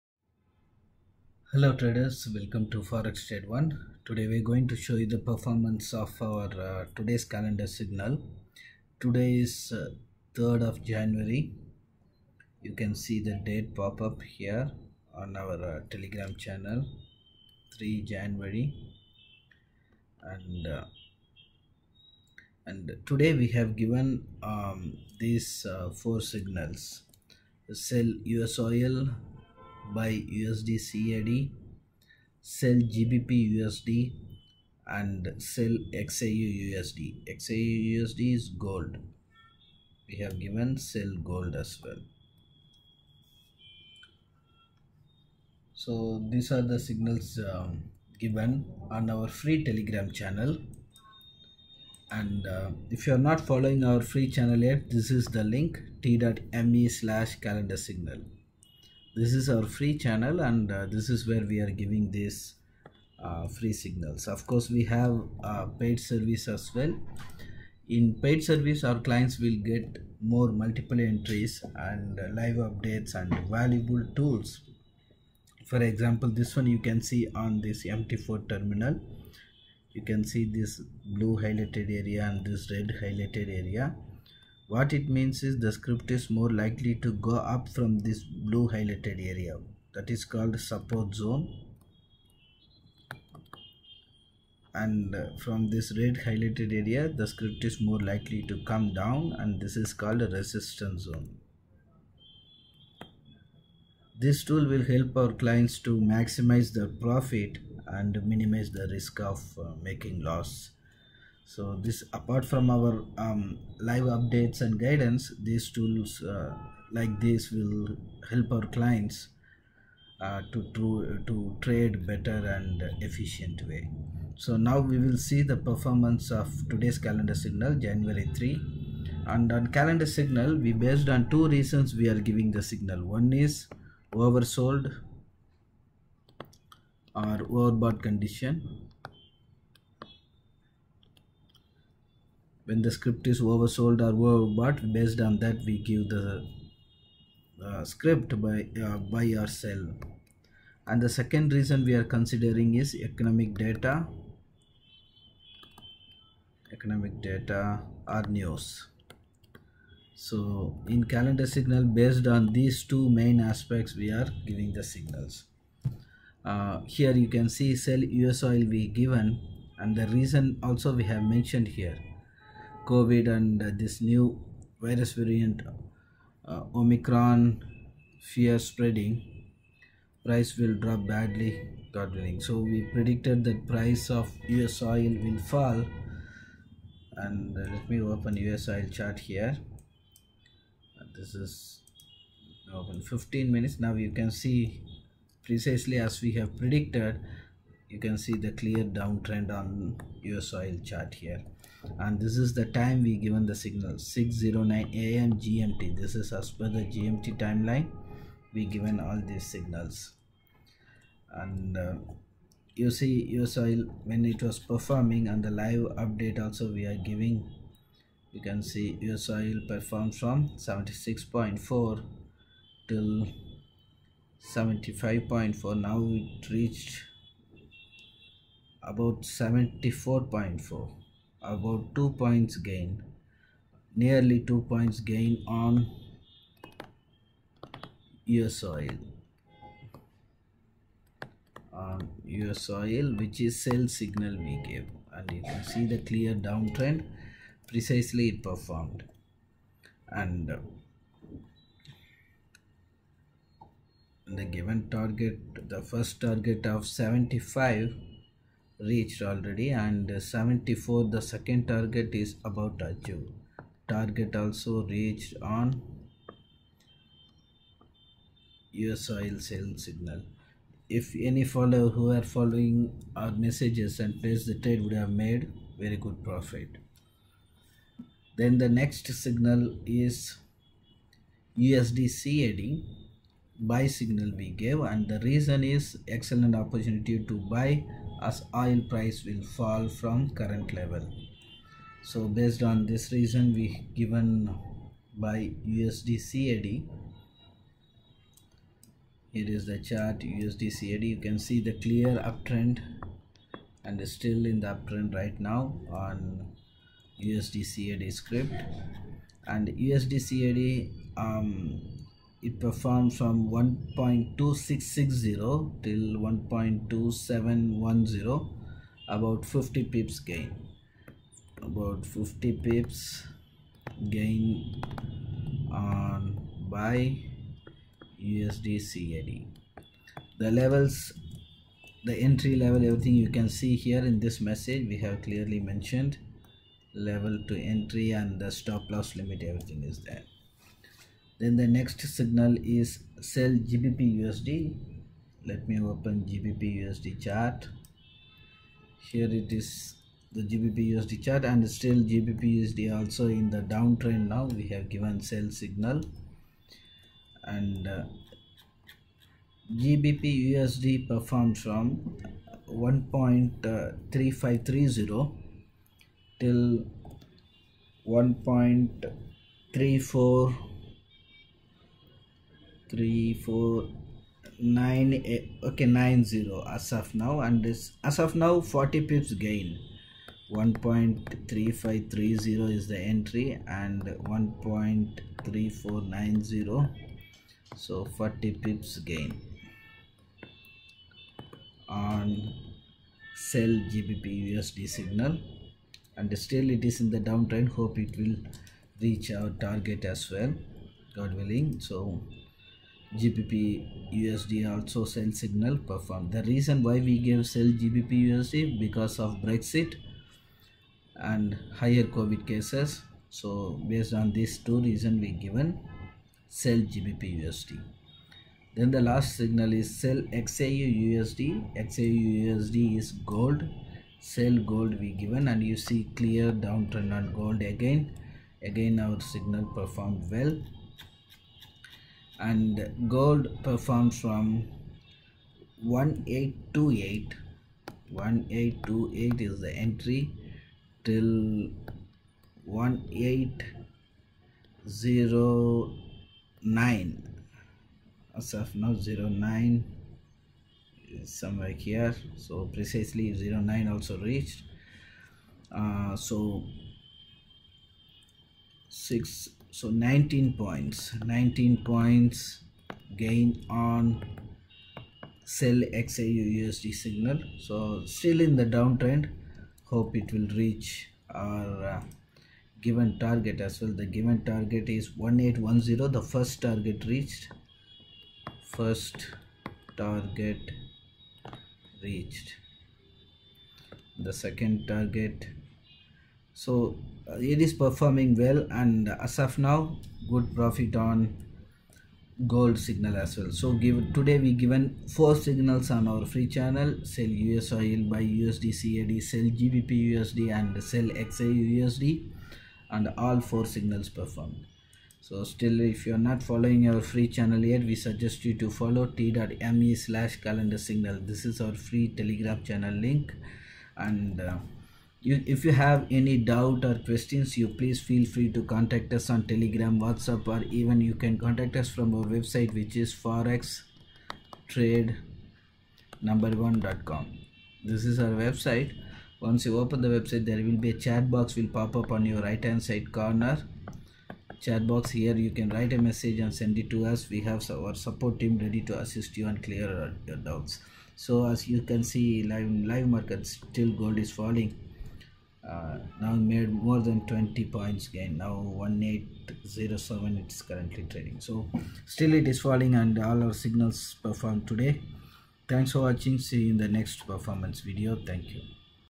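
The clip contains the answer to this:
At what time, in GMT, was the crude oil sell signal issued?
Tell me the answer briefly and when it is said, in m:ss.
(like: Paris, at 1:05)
6:09 am, at 3:23.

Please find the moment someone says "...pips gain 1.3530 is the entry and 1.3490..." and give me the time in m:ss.
6:19.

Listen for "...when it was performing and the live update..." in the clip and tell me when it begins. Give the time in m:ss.
3:34.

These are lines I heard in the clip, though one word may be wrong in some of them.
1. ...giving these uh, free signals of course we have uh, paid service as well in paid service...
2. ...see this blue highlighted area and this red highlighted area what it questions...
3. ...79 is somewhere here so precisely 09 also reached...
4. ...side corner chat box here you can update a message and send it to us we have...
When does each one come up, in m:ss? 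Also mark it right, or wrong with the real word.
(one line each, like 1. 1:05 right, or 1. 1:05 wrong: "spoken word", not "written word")
1. 1:01 right
2. 1:20 wrong: "means", not "questions"
3. 7:29 wrong: "09", not "79"
4. 8:52 wrong: "write", not "update".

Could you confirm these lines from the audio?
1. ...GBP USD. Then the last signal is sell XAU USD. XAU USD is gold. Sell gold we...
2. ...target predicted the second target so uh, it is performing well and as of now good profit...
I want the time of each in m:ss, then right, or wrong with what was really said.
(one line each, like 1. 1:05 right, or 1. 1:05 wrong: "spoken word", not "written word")
1. 6:56 right
2. 7:59 wrong: "reached", not "predicted".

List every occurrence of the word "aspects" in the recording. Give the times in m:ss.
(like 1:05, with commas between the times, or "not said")
2:43.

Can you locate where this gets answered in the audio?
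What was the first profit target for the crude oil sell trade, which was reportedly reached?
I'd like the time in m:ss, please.
4:16.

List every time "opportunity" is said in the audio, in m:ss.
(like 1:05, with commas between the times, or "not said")
4:46.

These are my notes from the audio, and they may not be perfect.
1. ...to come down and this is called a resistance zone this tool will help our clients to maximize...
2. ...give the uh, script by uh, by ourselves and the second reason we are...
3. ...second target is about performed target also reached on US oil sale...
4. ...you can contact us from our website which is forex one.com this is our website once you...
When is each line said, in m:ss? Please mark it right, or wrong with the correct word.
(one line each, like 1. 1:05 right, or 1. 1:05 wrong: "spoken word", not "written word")
1. 1:38 right
2. 2:25 right
3. 4:21 wrong: "achieved", not "performed"
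4. 8:41 right.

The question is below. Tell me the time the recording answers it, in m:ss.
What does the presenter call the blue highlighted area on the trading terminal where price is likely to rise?
1:30.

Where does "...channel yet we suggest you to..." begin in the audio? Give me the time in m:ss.
8:27.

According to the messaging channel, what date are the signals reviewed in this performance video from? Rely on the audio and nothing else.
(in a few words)
3 January.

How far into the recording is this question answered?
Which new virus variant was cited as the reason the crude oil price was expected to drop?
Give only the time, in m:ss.
2:56.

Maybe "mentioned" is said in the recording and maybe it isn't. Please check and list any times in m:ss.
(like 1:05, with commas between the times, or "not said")
2:51, 5:35.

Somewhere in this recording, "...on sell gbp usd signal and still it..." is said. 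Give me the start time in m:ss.
6:31.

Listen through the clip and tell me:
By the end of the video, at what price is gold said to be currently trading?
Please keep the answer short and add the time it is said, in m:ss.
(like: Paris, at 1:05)
1807, at 9:08.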